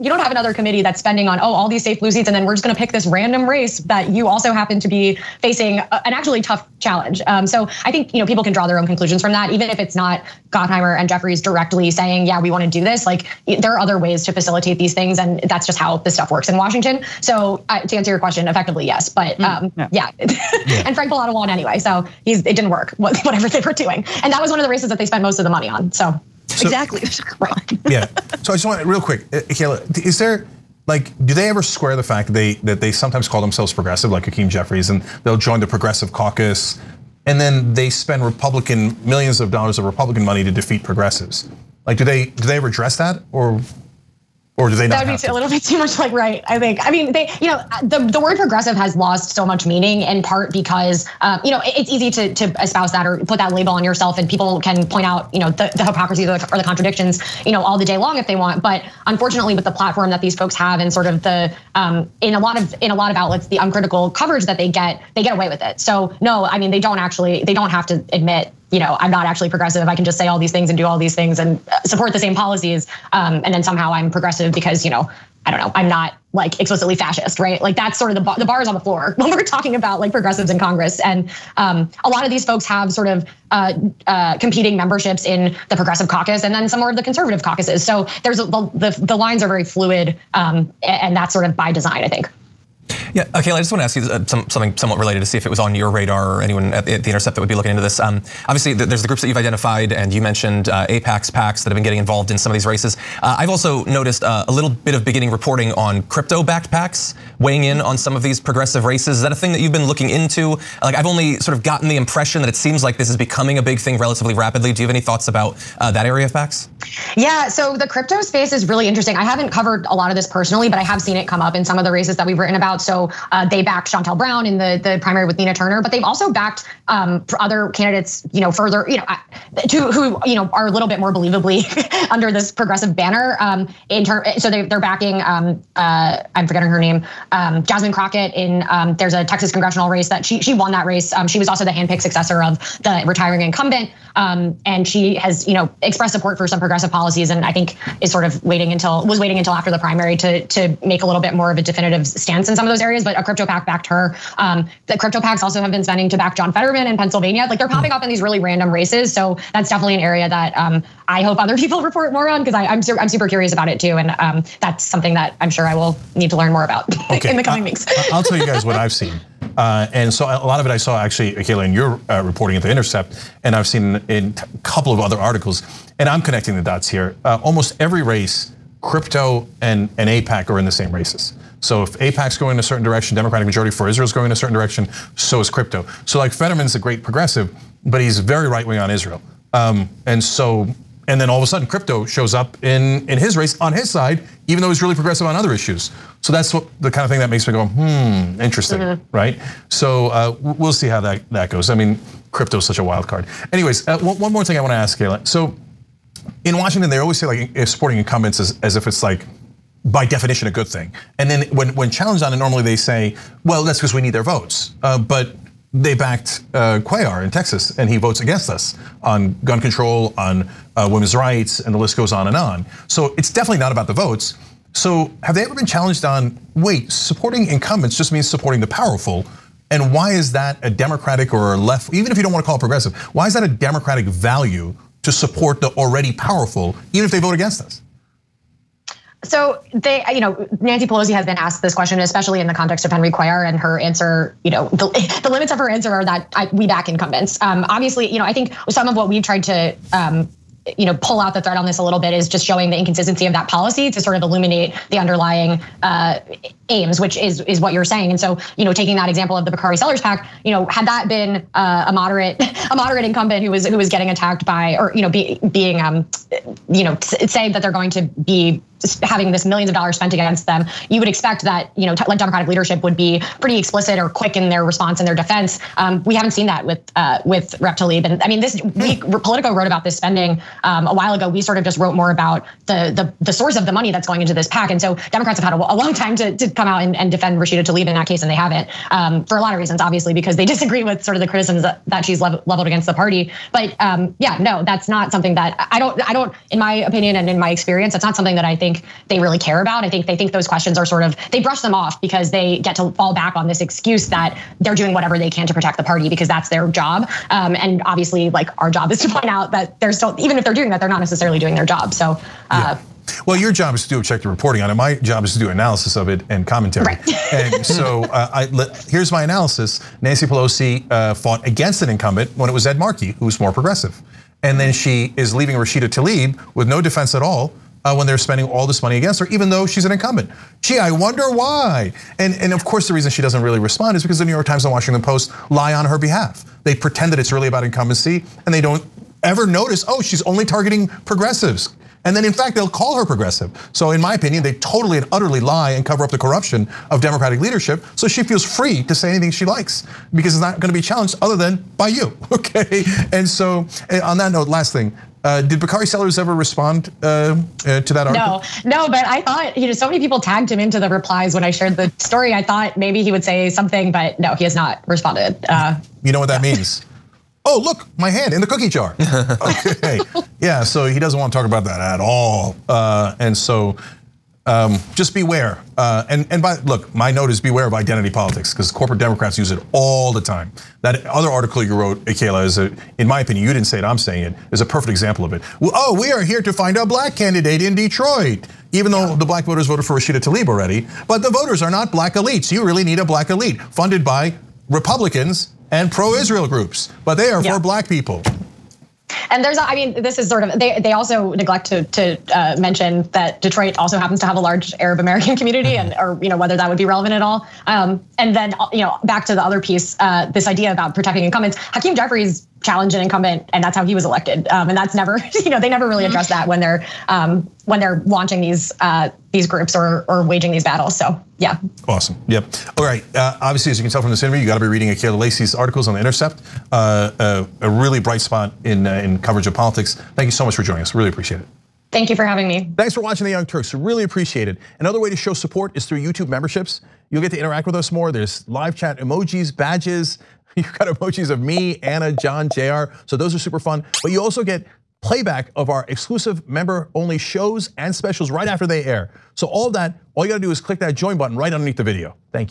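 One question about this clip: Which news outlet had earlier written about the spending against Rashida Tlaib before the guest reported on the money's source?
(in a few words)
Politico.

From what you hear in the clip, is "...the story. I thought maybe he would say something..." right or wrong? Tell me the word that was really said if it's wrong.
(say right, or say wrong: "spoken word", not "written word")
right.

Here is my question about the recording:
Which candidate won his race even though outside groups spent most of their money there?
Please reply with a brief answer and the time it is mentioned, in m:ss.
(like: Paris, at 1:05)
Frank Pallotta, at 0:20.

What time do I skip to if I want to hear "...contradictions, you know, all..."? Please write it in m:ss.
0:56.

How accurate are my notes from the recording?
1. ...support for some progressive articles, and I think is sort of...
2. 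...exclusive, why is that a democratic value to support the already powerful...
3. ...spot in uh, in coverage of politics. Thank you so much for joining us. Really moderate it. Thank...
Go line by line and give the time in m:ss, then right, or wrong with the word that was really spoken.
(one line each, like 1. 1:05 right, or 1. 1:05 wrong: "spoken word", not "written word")
1. 2:26 wrong: "policies", not "articles"
2. 3:52 wrong: "progressive", not "exclusive"
3. 7:08 wrong: "appreciate", not "moderate".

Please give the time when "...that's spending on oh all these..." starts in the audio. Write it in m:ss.
0:00.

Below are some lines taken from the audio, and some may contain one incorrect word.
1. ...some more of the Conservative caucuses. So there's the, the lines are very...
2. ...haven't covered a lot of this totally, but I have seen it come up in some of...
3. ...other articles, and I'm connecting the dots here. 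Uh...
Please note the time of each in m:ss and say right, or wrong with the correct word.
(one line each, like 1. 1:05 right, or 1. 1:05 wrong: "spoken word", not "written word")
1. 1:26 right
2. 1:59 wrong: "personally", not "totally"
3. 2:54 right.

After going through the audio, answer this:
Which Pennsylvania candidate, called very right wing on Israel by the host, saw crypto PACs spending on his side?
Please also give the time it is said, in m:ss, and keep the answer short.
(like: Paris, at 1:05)
John Fetterman, at 2:36.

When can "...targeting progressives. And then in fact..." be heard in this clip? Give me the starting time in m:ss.
5:40.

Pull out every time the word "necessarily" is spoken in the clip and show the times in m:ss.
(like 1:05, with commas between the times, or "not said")
5:10.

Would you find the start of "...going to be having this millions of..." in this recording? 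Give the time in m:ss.
4:27.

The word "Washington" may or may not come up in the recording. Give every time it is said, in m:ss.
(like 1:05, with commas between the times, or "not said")
0:16, 3:26, 5:34.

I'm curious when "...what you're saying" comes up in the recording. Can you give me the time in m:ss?
4:17.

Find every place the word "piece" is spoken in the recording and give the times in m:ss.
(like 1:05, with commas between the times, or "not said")
6:49.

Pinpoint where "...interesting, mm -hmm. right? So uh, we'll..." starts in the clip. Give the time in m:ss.
3:18.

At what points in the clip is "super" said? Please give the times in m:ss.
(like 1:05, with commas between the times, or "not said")
2:43, 7:23.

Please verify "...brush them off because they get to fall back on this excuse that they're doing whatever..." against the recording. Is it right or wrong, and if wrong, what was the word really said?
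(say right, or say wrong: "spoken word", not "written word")
right.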